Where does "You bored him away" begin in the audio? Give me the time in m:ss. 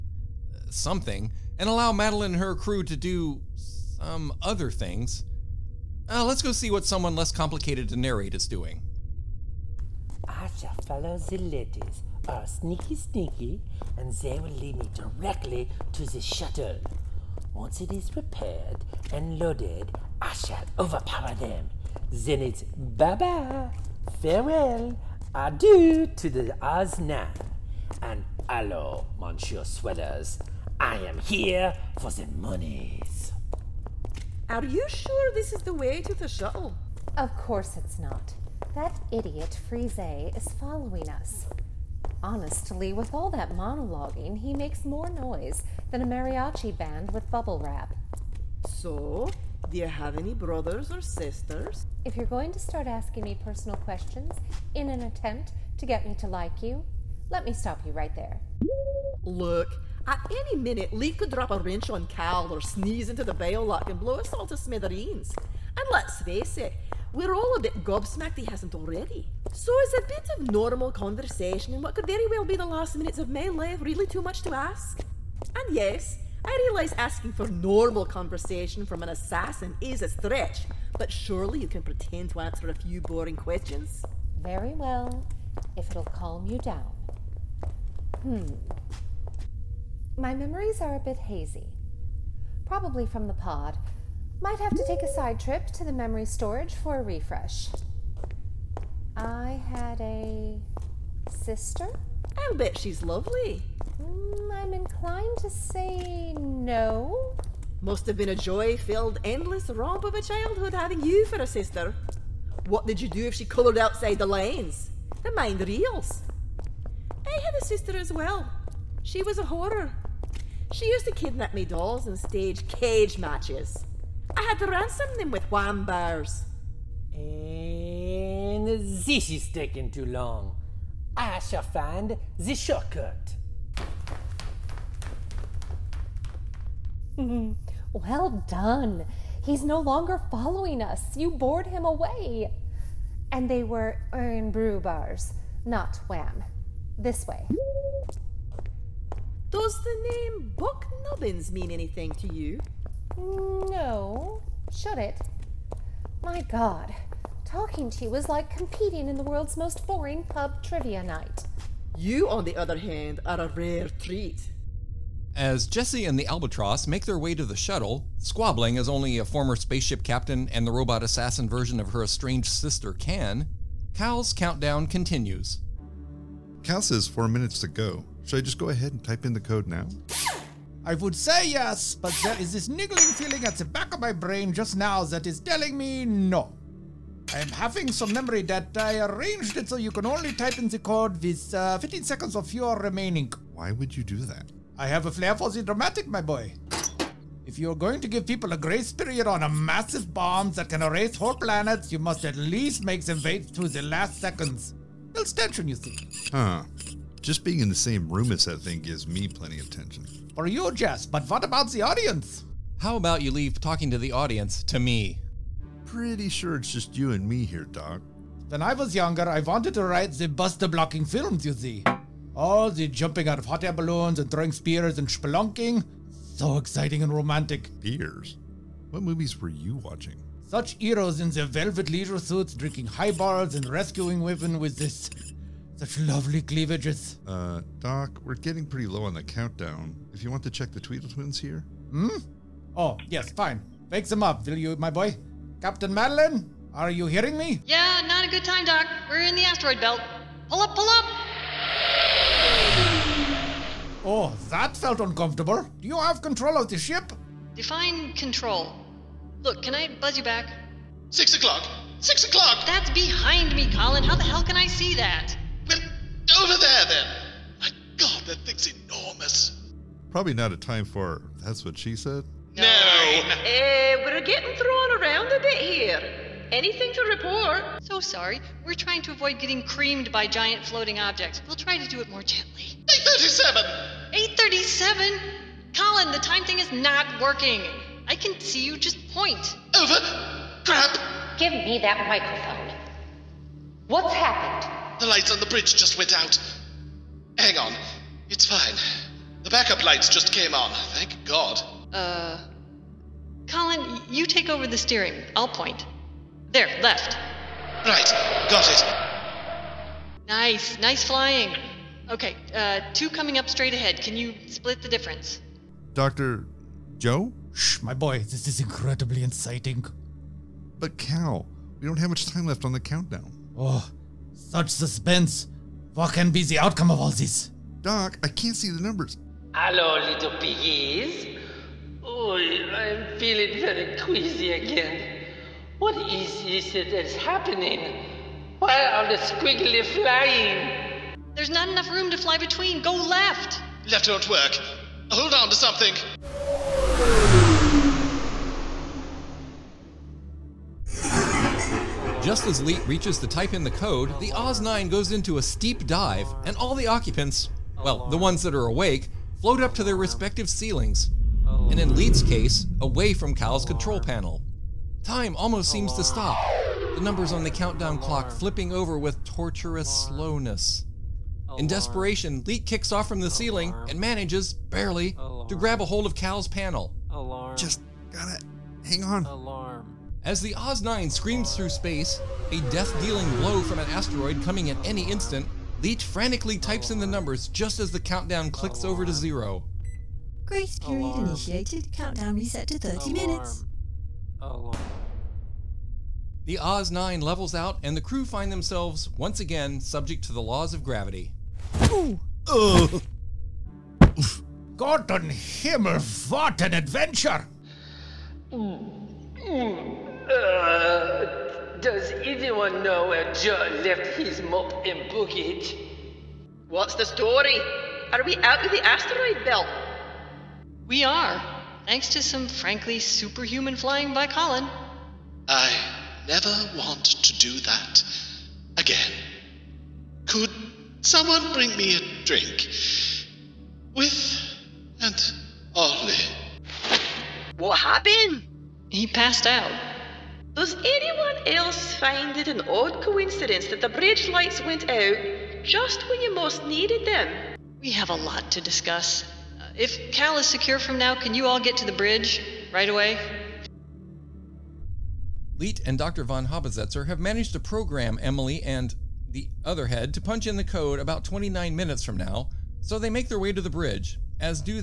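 2:21.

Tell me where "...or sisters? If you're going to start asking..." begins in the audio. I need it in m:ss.
0:50.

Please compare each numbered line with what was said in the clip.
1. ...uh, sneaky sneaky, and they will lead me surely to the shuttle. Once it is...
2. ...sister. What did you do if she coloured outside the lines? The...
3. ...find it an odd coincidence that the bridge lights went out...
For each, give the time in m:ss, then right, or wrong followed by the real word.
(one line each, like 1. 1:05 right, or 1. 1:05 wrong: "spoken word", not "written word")
1. 0:12 wrong: "directly", not "surely"
2. 1:51 right
3. 7:21 right.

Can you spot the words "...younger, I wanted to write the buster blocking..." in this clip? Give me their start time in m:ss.
3:38.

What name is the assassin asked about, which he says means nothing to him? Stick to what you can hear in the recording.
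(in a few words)
Buck Nubbins.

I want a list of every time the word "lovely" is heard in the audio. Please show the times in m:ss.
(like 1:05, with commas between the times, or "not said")
1:43, 3:55.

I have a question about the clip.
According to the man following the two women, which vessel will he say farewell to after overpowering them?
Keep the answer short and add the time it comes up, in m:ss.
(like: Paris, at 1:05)
Osnan, at 0:26.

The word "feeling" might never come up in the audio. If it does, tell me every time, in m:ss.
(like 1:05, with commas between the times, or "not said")
3:03, 5:33.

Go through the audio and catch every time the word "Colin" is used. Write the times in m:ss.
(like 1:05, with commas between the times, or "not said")
4:23, 4:45, 5:03, 7:04.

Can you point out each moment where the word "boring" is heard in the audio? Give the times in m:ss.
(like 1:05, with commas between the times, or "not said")
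1:23, 2:39.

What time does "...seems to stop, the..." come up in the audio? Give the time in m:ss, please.
6:05.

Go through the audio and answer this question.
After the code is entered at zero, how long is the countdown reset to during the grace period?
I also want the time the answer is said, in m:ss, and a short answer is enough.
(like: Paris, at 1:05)
30 minutes, at 6:32.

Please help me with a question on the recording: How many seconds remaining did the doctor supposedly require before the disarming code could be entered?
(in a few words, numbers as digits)
15.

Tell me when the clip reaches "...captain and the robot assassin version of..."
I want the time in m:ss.
2:50.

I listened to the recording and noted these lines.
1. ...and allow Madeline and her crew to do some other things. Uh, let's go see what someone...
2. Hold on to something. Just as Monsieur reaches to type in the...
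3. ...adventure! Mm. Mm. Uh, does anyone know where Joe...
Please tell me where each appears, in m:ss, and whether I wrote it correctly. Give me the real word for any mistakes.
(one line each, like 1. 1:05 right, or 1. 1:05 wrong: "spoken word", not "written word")
1. 0:01 right
2. 5:45 wrong: "Leet", not "Monsieur"
3. 6:46 right.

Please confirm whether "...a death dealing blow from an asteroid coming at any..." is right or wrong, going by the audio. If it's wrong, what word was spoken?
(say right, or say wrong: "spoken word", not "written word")
right.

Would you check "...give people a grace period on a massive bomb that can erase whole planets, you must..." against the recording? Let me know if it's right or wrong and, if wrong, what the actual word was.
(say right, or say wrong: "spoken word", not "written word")
right.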